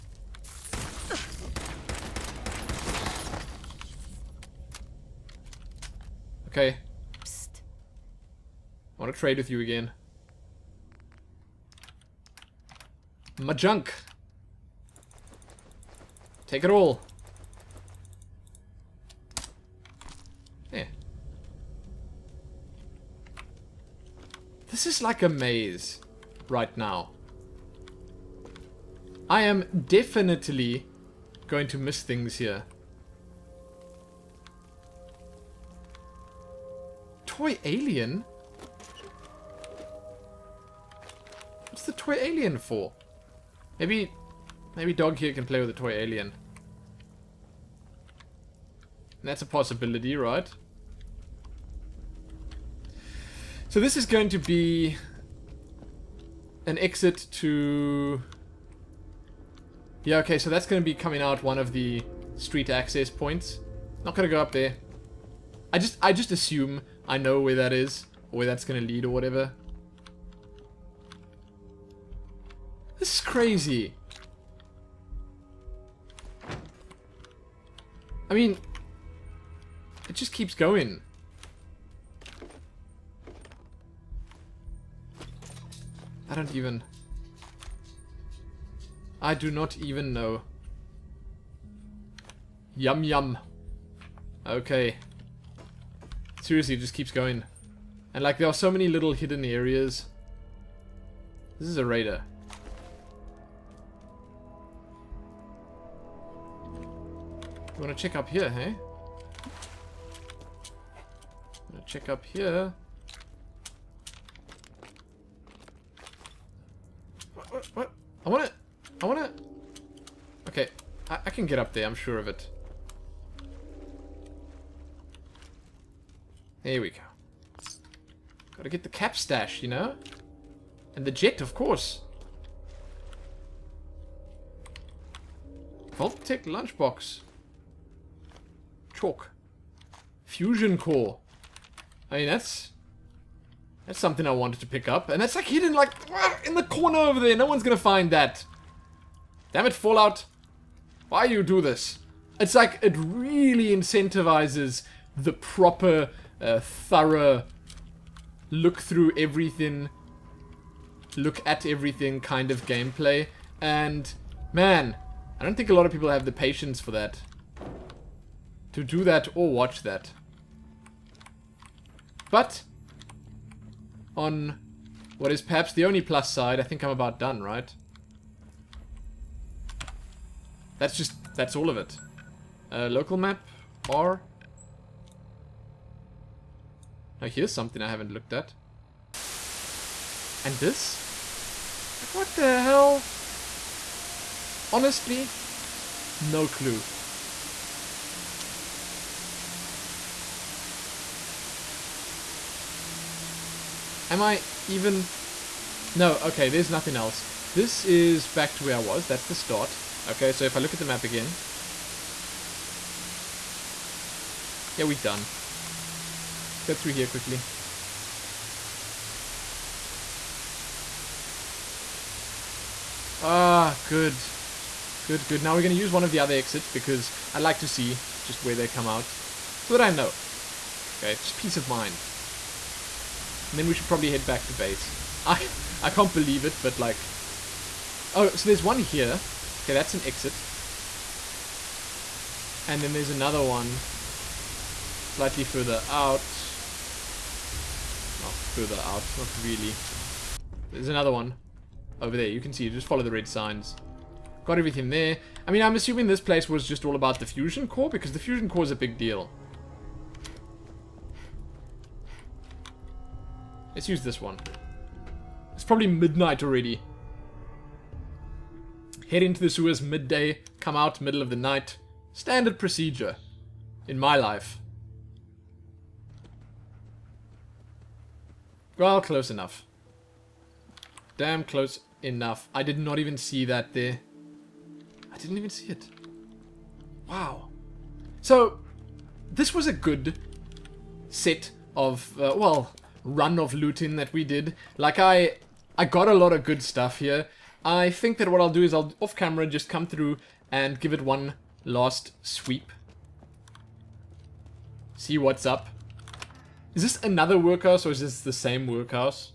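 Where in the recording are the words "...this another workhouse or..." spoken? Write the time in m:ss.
5:06.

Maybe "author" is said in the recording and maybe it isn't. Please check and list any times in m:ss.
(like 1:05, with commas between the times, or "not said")
not said.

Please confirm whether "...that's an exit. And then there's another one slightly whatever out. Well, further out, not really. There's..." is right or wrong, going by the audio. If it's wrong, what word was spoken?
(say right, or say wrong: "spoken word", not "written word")
wrong: "further", not "whatever".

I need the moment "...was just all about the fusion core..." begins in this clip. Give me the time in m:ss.
4:16.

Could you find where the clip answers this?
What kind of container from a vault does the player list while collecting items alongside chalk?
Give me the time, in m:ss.
2:15.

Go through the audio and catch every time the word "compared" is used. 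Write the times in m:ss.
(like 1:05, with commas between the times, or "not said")
not said.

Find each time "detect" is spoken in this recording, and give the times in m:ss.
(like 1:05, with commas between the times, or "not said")
not said.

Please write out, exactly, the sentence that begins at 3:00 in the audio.
That's just, that's all of it.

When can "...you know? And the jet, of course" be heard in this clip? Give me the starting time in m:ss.
2:09.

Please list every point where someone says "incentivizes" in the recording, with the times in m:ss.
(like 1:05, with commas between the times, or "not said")
2:33.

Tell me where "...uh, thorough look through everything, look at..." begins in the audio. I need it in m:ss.
2:36.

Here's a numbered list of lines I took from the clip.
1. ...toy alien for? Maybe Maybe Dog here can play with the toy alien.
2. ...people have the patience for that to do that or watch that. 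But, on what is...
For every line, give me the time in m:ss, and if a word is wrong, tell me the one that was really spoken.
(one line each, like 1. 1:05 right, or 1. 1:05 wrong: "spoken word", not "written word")
1. 0:41 right
2. 2:45 right.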